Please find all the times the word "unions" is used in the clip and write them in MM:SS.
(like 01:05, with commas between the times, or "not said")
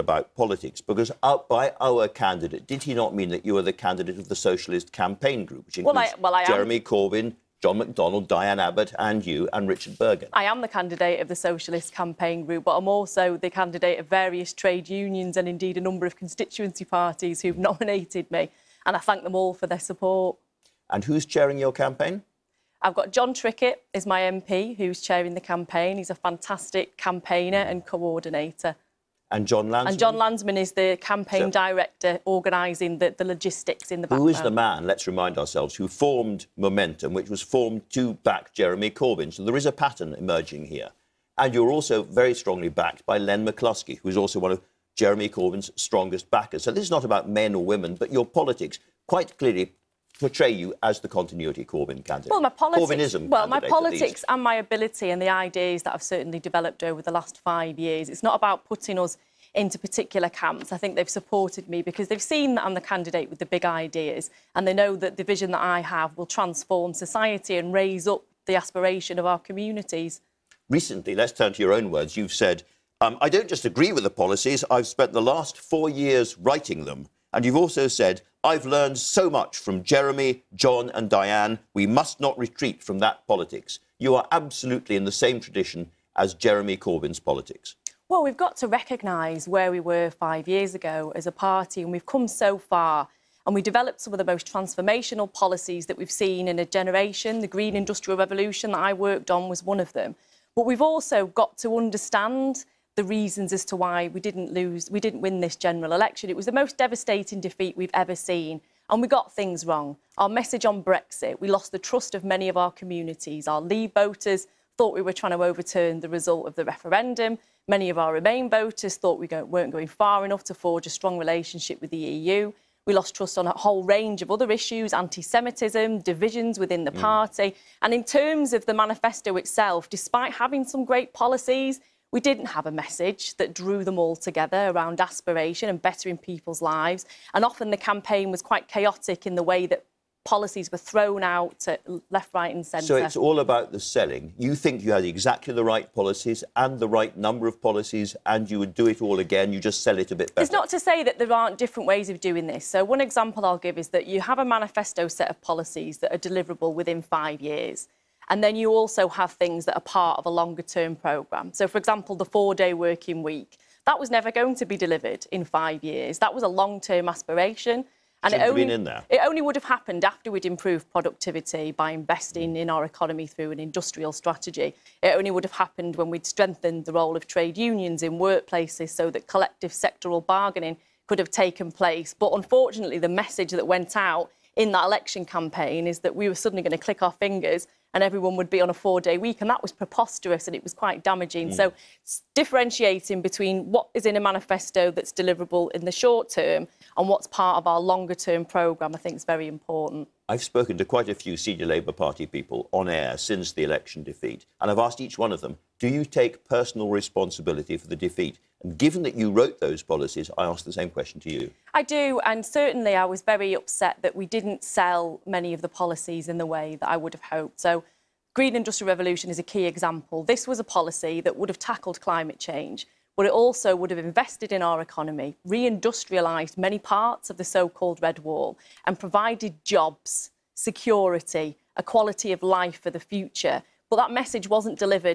00:14, 02:57.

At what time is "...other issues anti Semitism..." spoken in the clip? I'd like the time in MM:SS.
02:04.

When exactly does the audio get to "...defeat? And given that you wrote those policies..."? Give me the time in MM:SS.
03:27.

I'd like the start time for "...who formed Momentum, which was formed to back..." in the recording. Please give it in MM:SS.
00:35.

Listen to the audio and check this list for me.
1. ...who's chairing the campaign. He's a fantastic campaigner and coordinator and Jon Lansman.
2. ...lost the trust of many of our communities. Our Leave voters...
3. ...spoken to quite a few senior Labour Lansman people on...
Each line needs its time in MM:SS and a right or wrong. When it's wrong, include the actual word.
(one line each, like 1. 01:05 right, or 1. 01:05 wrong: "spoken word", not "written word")
1. 00:24 right
2. 01:51 right
3. 03:20 wrong: "Party", not "Lansman".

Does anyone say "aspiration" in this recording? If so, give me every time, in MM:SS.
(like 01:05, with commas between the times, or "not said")
01:08, 02:15, 02:47.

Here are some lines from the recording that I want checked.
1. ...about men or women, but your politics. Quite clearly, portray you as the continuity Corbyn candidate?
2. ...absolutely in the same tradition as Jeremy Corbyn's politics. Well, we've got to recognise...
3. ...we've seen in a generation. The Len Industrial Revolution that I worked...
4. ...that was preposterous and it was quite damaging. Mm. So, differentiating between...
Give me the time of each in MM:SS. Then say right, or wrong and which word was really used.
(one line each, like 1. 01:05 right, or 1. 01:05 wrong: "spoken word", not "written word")
1. 00:47 right
2. 01:24 right
3. 01:35 wrong: "Green", not "Len"
4. 03:09 right.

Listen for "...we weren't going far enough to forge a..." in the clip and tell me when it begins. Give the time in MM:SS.
01:59.